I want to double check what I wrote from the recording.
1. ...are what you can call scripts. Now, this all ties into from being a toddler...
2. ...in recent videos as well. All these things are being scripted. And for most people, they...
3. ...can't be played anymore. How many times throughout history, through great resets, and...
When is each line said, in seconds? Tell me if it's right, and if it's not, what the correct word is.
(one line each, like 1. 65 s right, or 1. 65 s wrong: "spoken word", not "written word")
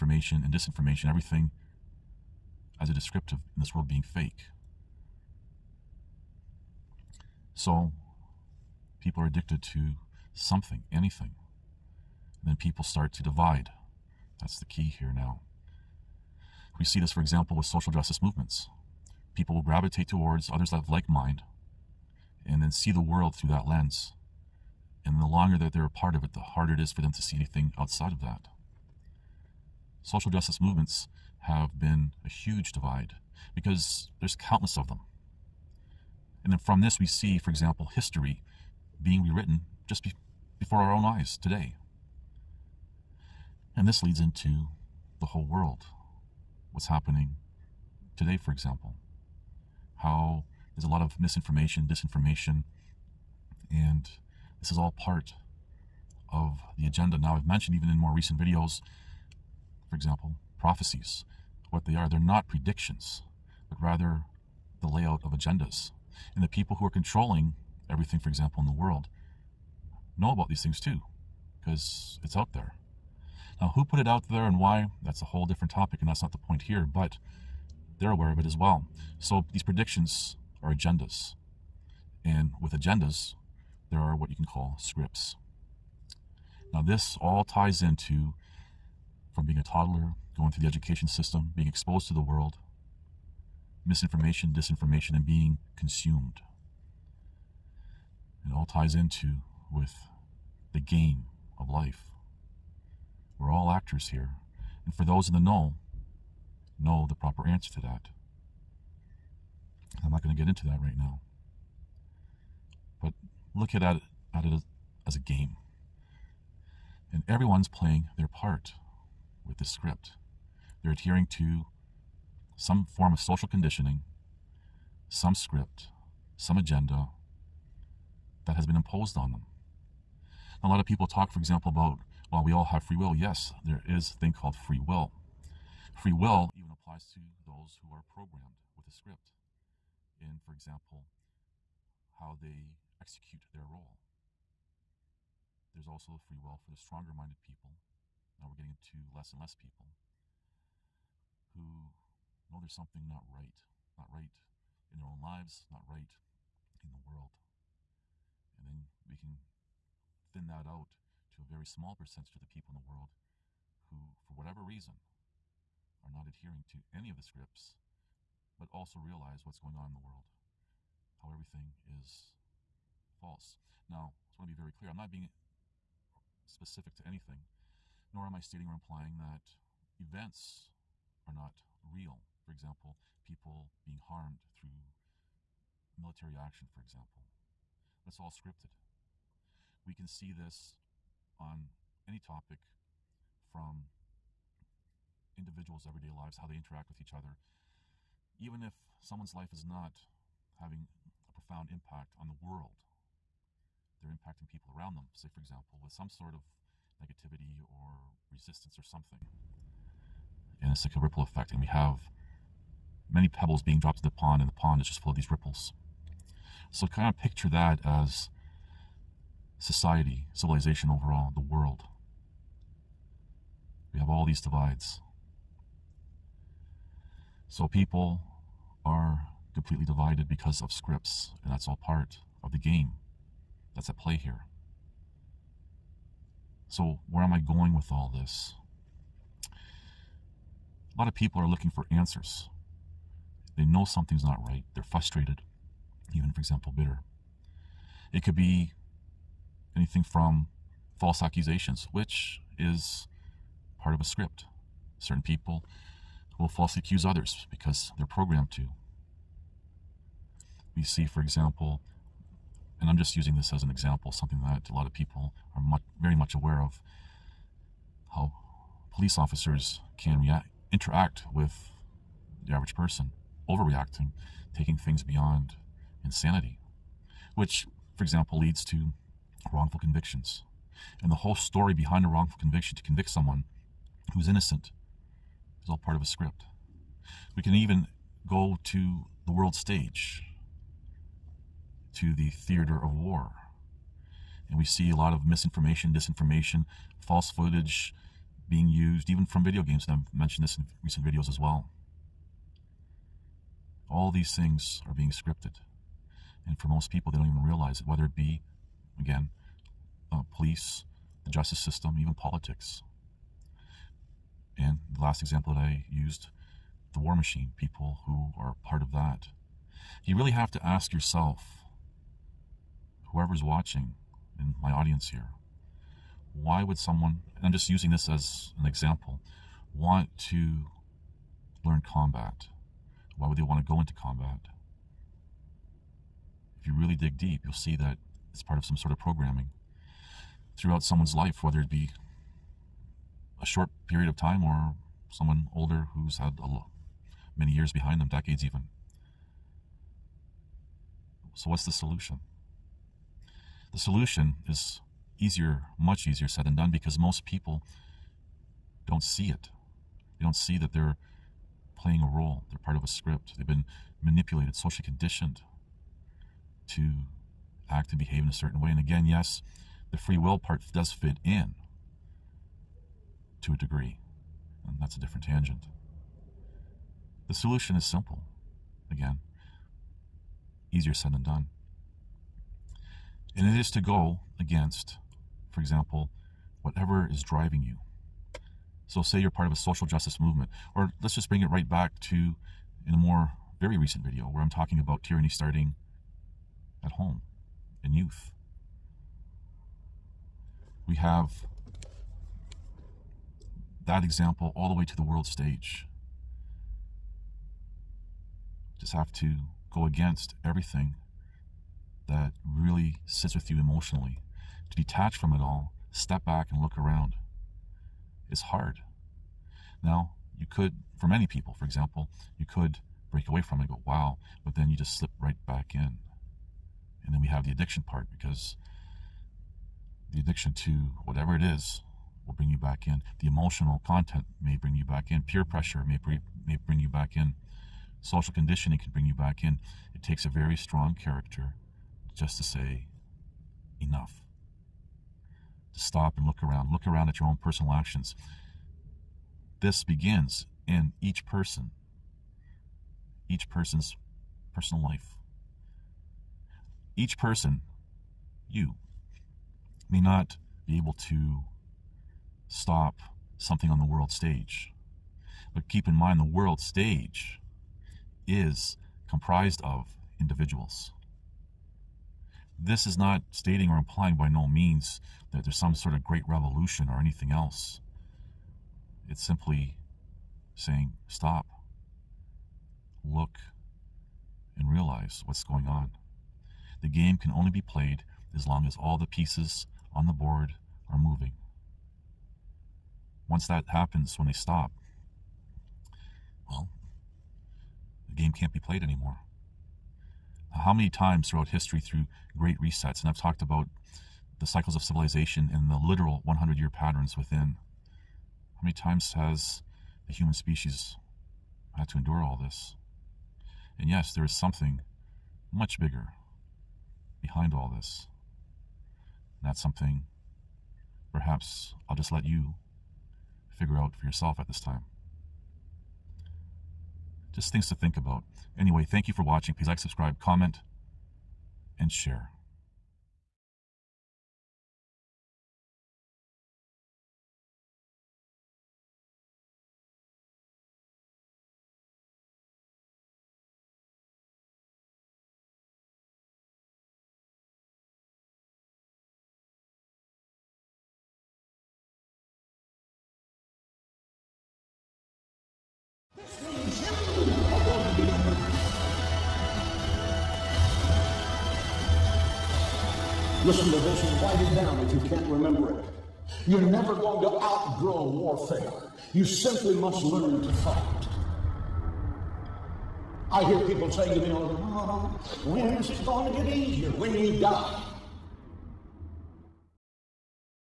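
1. 83 s right
2. 300 s right
3. 498 s right.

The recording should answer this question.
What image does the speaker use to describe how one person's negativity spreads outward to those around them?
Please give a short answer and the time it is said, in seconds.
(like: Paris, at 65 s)
A ripple effect, at 210 s.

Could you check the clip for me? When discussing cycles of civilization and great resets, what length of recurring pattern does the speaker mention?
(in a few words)
100 year.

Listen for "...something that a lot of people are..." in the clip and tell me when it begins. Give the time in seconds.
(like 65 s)
264 s.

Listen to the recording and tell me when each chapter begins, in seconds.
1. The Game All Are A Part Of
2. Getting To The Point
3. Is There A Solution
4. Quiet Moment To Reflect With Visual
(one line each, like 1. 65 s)
1. 76 s
2. 213 s
3. 328 s
4. 512 s.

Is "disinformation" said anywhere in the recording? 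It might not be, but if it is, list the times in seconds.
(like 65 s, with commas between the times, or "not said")
0 s, 51 s, 94 s, 295 s.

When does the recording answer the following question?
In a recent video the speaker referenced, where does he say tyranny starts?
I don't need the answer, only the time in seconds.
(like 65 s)
396 s.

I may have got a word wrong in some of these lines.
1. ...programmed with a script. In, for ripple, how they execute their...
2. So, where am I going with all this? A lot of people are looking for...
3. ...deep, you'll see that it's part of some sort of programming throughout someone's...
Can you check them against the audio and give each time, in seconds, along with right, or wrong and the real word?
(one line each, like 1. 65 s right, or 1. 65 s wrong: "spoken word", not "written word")
1. 138 s wrong: "example", not "ripple"
2. 236 s right
3. 337 s right.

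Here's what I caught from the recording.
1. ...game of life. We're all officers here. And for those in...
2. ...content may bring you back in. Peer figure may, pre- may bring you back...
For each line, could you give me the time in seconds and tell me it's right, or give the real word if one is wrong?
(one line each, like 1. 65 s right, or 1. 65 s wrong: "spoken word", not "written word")
1. 100 s wrong: "actors", not "officers"
2. 433 s wrong: "pressure", not "figure".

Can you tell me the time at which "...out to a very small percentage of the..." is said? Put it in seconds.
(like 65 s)
160 s.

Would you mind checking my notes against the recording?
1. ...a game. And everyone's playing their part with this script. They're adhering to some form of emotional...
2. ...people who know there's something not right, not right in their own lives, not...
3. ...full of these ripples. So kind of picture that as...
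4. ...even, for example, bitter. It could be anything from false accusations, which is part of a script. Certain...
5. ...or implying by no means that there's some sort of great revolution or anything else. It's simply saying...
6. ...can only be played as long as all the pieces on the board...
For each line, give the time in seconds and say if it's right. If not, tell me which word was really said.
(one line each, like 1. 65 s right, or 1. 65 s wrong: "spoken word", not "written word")
1. 115 s wrong: "social", not "emotional"
2. 149 s right
3. 214 s right
4. 246 s right
5. 473 s right
6. 487 s right.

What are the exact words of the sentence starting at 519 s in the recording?
And that's something perhaps I'll just let you figure out for yourself at this time.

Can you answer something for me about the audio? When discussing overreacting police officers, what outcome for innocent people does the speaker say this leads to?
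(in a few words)
Wrongful convictions.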